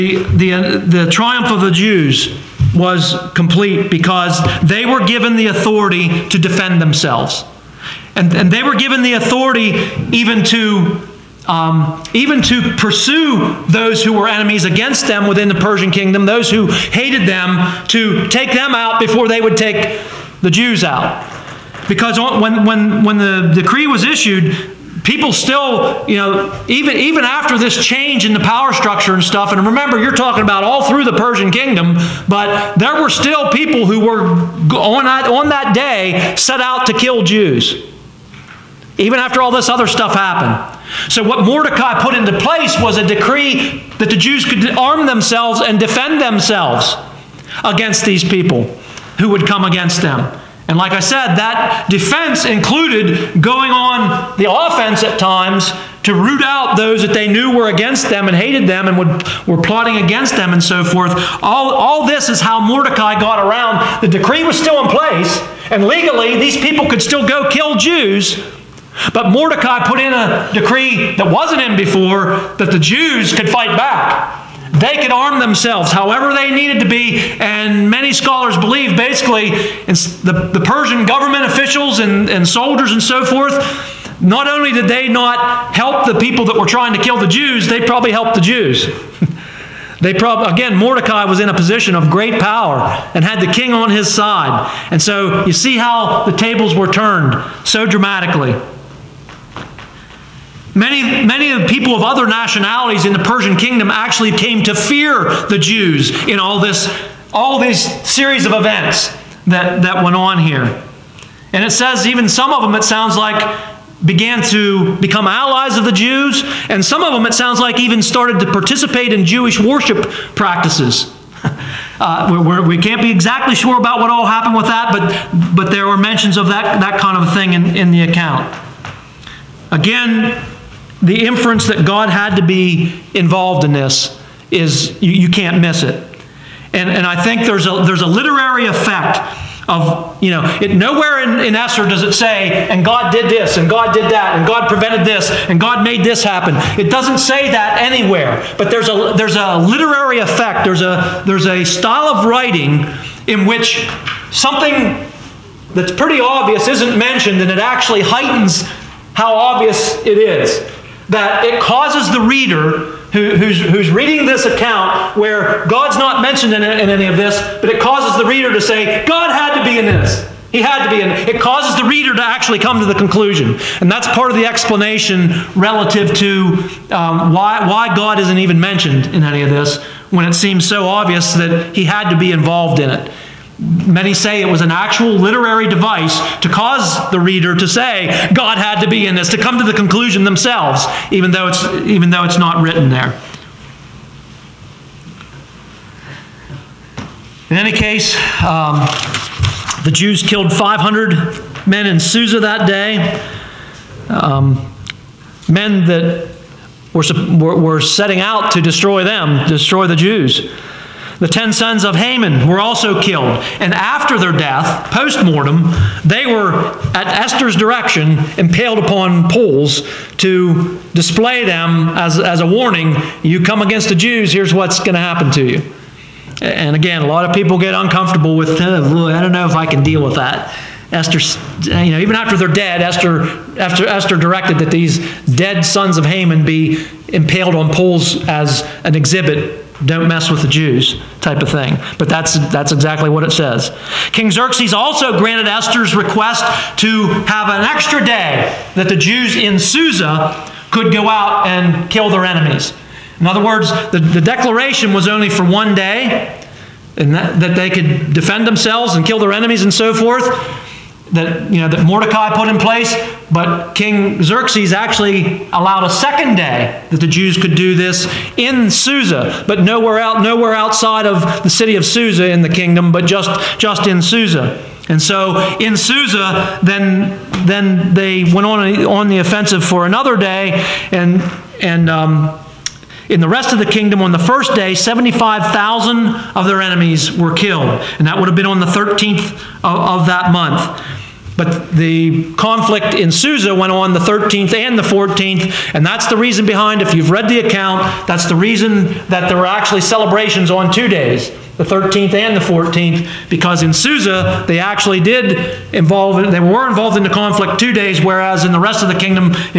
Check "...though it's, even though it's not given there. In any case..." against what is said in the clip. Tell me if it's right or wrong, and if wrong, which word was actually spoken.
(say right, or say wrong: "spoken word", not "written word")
wrong: "written", not "given".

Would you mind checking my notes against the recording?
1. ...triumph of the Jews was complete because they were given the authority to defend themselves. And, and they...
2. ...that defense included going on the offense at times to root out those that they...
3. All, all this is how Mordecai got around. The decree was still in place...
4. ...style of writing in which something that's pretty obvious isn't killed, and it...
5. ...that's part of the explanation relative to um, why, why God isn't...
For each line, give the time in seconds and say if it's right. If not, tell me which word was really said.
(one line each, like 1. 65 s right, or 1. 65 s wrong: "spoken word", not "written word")
1. 1 s right
2. 51 s right
3. 61 s right
4. 151 s wrong: "mentioned", not "killed"
5. 173 s right.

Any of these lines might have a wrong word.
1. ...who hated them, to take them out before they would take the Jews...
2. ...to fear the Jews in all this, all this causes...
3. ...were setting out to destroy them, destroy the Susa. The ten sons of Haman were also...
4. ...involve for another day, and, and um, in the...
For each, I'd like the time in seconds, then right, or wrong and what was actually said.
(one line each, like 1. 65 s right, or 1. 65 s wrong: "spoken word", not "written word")
1. 16 s right
2. 104 s wrong: "series", not "causes"
3. 207 s wrong: "Jews", not "Susa"
4. 279 s wrong: "offensive", not "involve".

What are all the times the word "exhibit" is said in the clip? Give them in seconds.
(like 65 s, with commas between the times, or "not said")
238 s.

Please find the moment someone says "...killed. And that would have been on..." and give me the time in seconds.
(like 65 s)
287 s.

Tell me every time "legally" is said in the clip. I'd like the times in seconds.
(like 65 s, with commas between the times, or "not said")
65 s.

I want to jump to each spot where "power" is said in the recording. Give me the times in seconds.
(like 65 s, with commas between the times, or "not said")
28 s, 92 s.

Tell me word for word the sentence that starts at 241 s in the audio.
But that's, that's exactly what it says.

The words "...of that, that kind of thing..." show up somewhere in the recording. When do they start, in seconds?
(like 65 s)
126 s.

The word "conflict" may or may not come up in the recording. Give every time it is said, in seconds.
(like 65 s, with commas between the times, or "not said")
292 s, 307 s.